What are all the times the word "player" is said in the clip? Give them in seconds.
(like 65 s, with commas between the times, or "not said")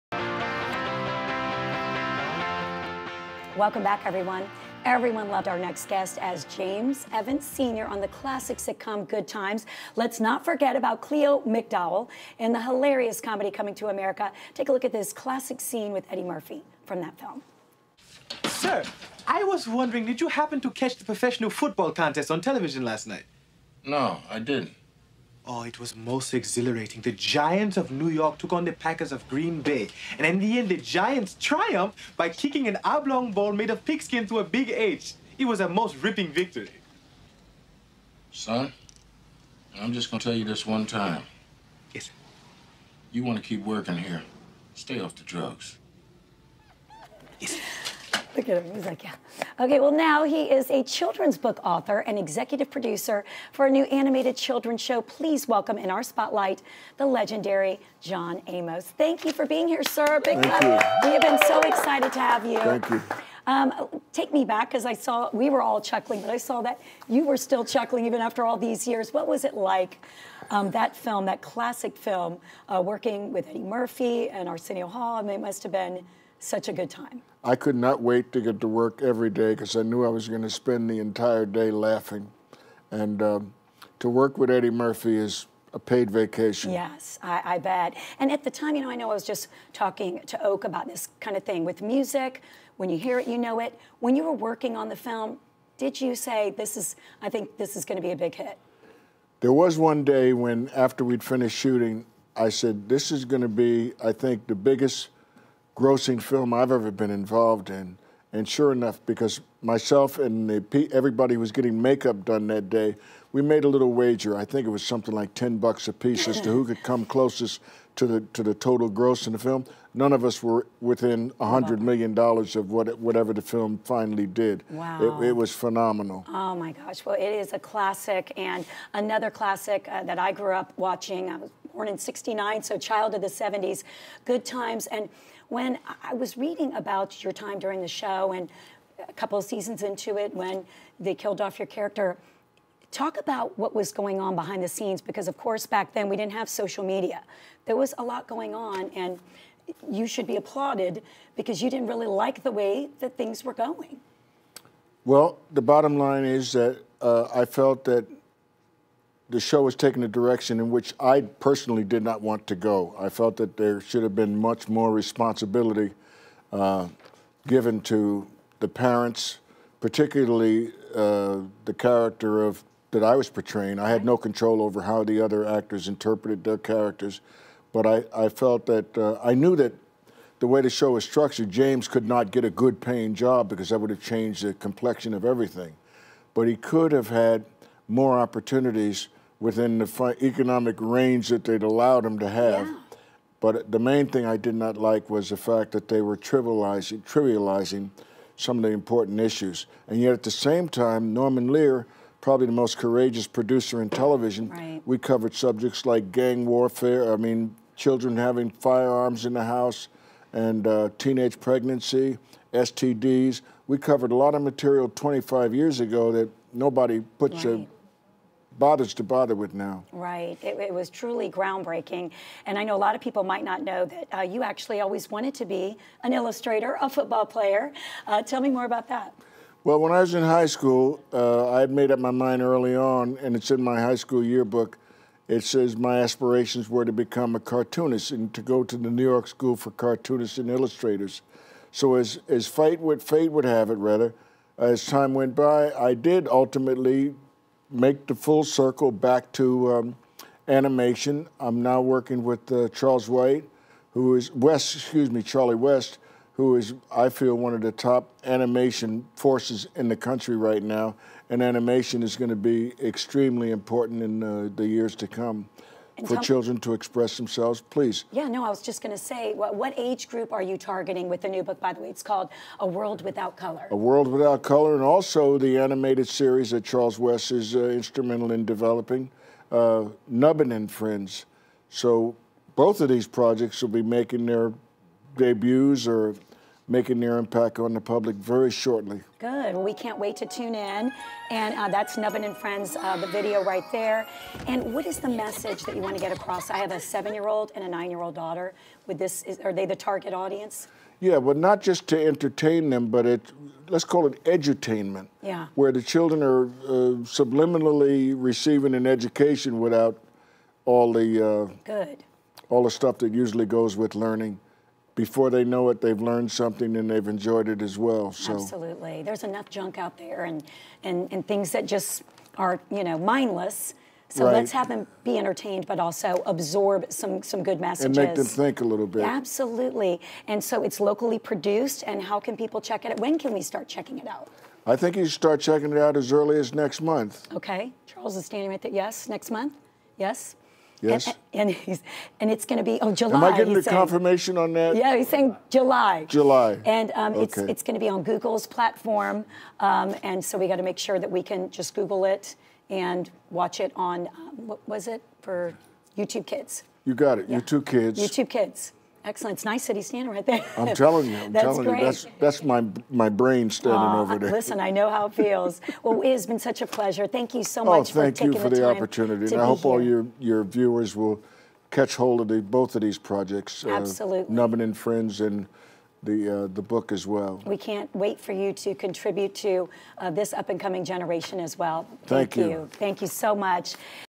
227 s.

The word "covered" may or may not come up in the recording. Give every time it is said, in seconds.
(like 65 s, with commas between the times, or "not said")
204 s, 213 s.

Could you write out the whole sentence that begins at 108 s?
And sure enough, because myself and the, everybody was getting makeup done that day, we made a little wager.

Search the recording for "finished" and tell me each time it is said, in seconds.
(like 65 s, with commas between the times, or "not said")
101 s.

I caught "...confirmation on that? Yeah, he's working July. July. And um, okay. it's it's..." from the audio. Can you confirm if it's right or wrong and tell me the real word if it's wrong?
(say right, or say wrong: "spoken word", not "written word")
wrong: "saying", not "working".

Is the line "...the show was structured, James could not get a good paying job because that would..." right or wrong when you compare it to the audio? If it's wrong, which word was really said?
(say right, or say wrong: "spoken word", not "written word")
right.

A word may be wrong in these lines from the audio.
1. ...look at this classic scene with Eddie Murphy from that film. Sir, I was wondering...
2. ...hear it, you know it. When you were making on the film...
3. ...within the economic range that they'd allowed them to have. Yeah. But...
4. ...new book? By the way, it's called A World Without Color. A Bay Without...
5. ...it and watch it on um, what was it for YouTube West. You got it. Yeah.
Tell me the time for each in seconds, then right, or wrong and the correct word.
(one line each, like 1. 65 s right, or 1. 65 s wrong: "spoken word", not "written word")
1. 14 s right
2. 92 s wrong: "working", not "making"
3. 189 s right
4. 271 s wrong: "World", not "Bay"
5. 352 s wrong: "Kids", not "West".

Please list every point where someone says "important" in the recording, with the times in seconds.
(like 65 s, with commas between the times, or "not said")
198 s, 263 s.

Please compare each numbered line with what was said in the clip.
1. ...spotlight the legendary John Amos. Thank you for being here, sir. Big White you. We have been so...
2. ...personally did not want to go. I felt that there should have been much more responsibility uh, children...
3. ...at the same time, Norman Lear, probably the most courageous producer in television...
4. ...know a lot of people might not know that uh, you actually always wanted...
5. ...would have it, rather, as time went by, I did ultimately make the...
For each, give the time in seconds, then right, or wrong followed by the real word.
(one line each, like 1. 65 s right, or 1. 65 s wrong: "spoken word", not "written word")
1. 56 s wrong: "Thank", not "White"
2. 161 s wrong: "given", not "children"
3. 200 s right
4. 222 s right
5. 243 s right.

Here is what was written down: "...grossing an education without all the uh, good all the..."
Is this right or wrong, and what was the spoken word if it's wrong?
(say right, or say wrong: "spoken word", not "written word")
wrong: "receiving", not "grossing".